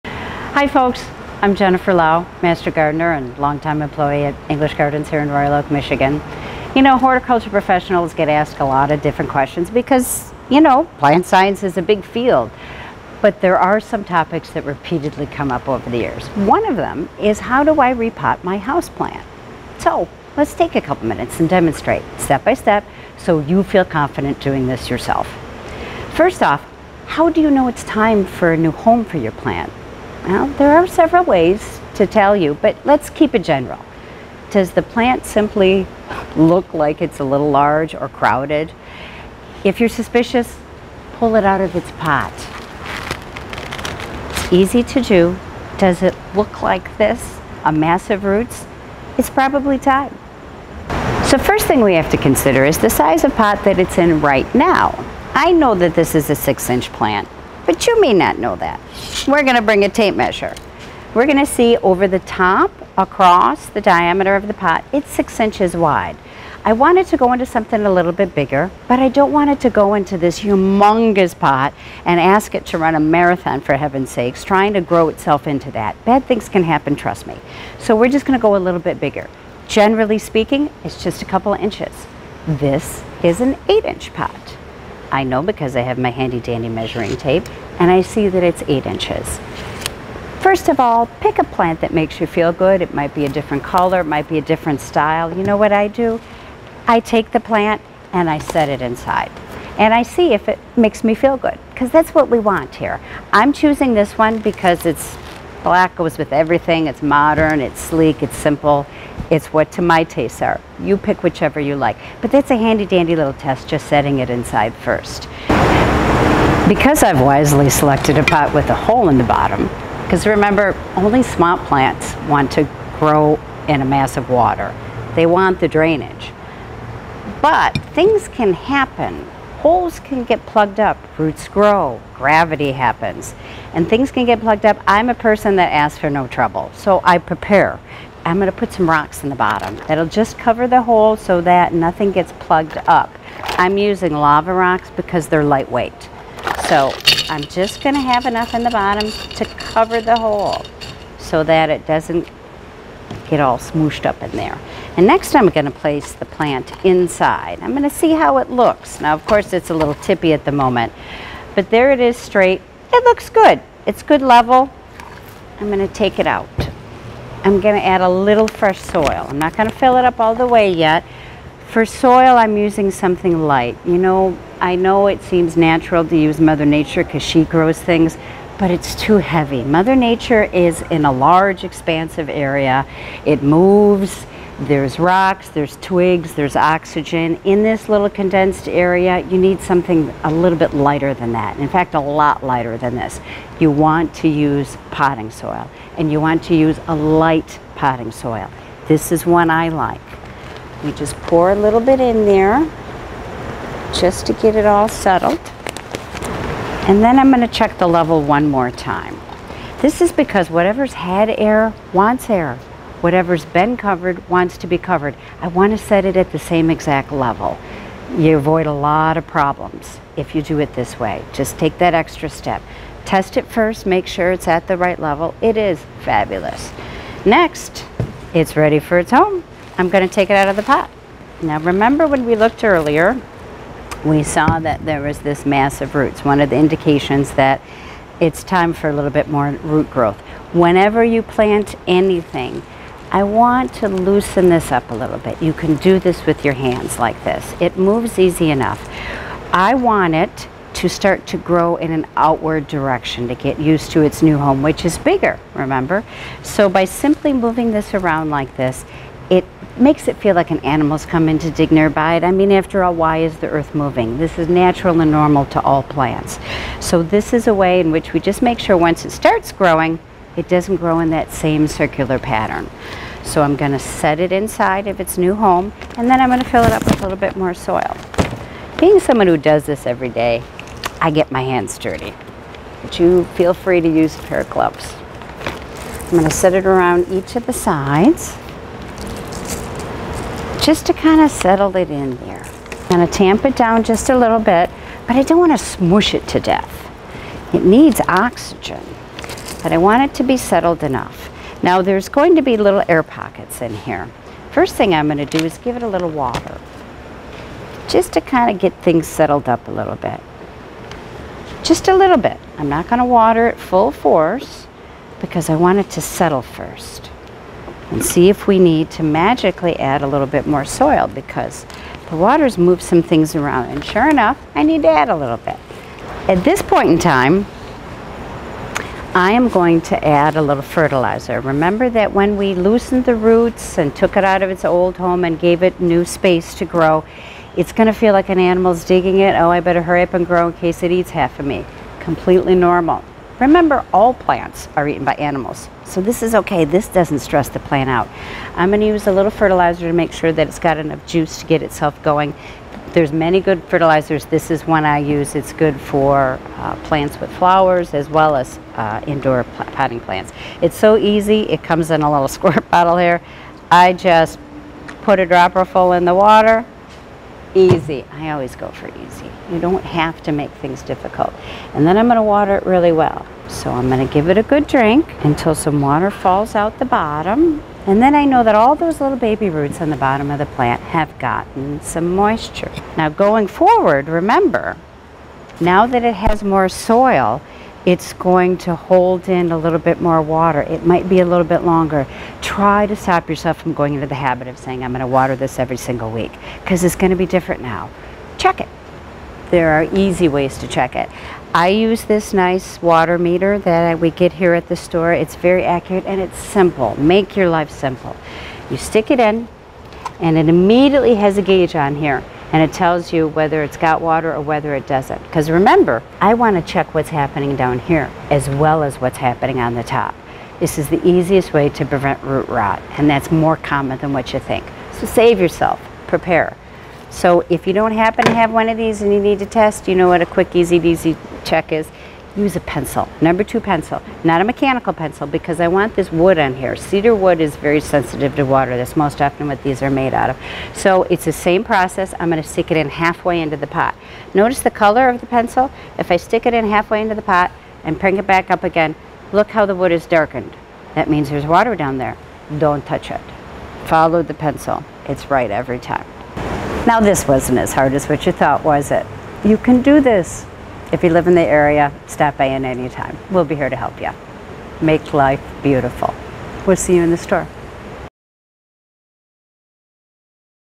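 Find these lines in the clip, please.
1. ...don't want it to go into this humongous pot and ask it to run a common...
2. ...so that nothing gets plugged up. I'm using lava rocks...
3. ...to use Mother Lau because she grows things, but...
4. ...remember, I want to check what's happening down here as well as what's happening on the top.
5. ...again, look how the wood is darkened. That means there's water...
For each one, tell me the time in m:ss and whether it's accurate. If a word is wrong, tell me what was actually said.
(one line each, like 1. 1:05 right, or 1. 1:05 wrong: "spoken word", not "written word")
1. 1:09 wrong: "marathon", not "common"
2. 2:21 right
3. 2:56 wrong: "Nature", not "Lau"
4. 6:55 right
5. 7:28 right.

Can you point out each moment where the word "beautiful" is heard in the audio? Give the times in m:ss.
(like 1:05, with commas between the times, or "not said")
7:45.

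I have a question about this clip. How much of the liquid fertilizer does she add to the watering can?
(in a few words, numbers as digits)
A dropper full.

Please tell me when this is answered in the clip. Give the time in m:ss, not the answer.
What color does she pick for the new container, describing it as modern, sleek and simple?
1:45.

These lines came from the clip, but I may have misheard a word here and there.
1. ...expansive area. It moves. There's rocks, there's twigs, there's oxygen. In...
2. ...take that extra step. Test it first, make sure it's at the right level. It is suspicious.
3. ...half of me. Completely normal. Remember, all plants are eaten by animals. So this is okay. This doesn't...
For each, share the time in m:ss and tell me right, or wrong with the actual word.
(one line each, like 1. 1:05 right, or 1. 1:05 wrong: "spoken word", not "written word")
1. 3:01 right
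2. 3:41 wrong: "fabulous", not "suspicious"
3. 5:41 right.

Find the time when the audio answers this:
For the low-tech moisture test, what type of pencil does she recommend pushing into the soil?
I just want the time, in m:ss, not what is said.
7:13.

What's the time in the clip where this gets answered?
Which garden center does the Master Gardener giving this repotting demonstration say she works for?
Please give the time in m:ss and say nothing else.
0:04.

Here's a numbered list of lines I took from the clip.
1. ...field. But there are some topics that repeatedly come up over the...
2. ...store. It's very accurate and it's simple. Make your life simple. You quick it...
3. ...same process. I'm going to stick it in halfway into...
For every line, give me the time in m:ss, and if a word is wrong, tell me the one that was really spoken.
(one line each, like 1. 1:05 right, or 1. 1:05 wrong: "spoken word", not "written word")
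1. 0:12 right
2. 6:44 wrong: "stick", not "quick"
3. 7:21 right.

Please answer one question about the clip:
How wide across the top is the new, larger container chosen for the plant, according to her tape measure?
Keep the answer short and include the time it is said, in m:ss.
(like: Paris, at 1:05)
8 inches, at 1:23.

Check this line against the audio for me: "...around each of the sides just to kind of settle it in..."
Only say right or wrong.
right.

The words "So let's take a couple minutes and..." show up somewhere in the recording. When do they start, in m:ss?
0:19.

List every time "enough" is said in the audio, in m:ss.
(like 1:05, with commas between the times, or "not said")
2:28, 4:08, 5:00, 5:24, 5:50.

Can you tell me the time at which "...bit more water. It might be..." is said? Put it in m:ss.
6:29.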